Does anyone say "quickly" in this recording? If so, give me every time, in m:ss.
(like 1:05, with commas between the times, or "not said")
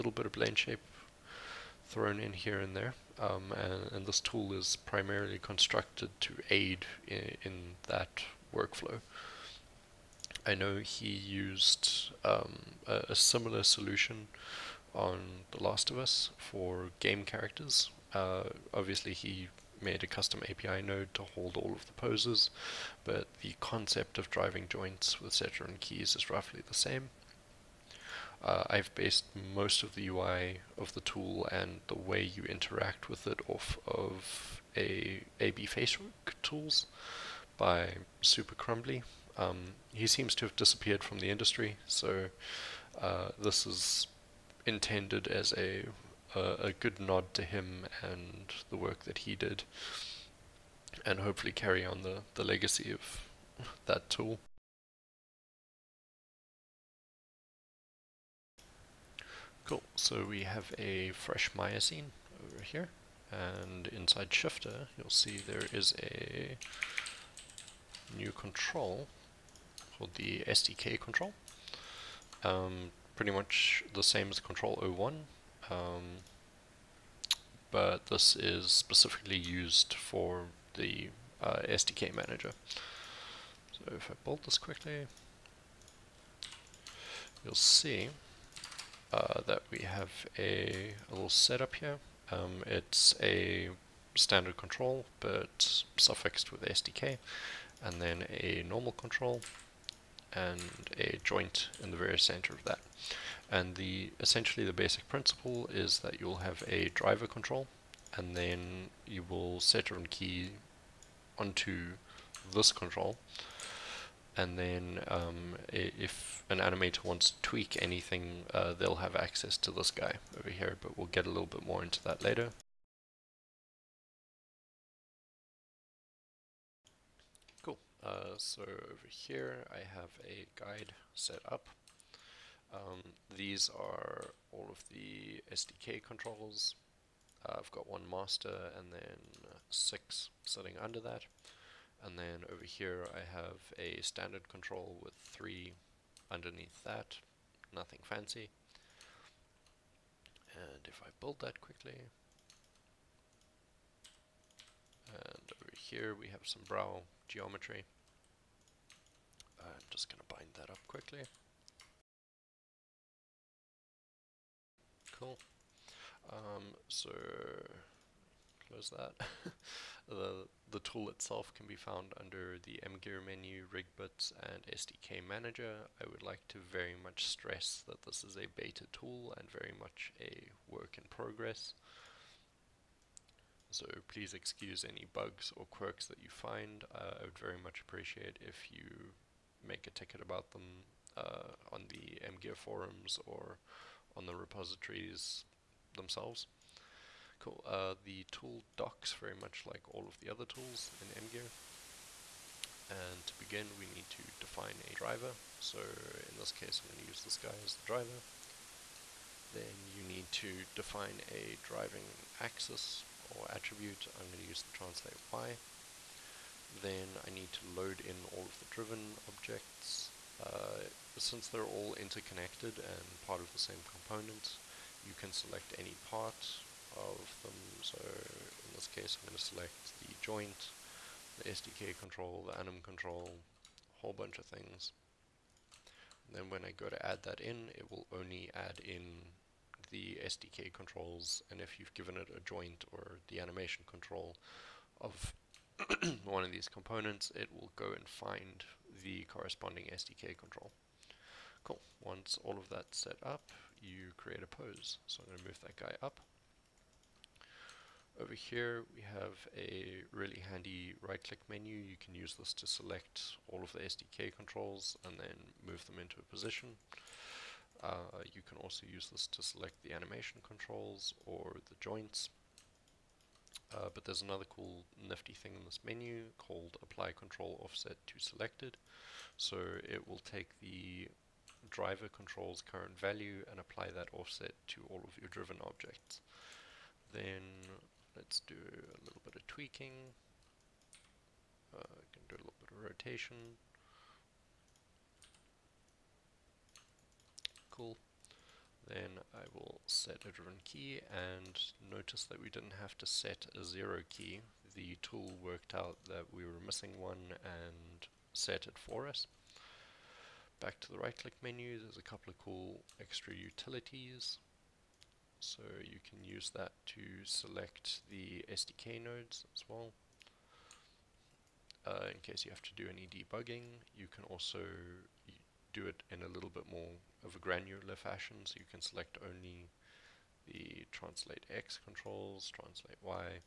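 1:24, 2:31, 2:40.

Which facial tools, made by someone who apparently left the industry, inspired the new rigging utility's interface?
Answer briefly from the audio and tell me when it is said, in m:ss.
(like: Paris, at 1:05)
Super Crumbly, at 0:38.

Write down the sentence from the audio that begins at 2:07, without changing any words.
Cool, uh, so over here I have a guide set up um, these are all of the SDK controls.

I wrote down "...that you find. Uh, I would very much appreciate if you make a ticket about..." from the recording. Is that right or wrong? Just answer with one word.
right.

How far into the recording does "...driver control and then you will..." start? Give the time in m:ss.
1:46.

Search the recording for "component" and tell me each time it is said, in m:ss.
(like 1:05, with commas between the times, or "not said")
3:43, 4:06.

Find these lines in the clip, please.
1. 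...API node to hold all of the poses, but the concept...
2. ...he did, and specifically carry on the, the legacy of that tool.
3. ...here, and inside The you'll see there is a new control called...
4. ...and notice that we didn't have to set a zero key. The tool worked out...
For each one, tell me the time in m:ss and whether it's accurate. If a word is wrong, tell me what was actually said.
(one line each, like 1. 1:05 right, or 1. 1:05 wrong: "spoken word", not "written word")
1. 0:20 right
2. 0:49 wrong: "hopefully", not "specifically"
3. 1:02 wrong: "Shifter", not "The"
4. 5:01 right.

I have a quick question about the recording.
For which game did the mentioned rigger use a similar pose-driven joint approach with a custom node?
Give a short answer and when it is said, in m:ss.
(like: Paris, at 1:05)
The Last of Us, at 0:15.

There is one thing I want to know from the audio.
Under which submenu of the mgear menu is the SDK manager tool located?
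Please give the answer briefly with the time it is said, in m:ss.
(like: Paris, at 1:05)
rigbits, at 2:53.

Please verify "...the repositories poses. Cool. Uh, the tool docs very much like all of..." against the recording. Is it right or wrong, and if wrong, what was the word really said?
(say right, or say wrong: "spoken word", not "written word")
wrong: "themselves", not "poses".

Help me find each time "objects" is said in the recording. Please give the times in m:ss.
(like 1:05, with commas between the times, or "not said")
3:39, 4:45.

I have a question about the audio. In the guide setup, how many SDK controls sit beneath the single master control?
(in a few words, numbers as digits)
6.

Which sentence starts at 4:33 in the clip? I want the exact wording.
Uh, but there's another cool nifty thing in this menu called apply control offset to selected.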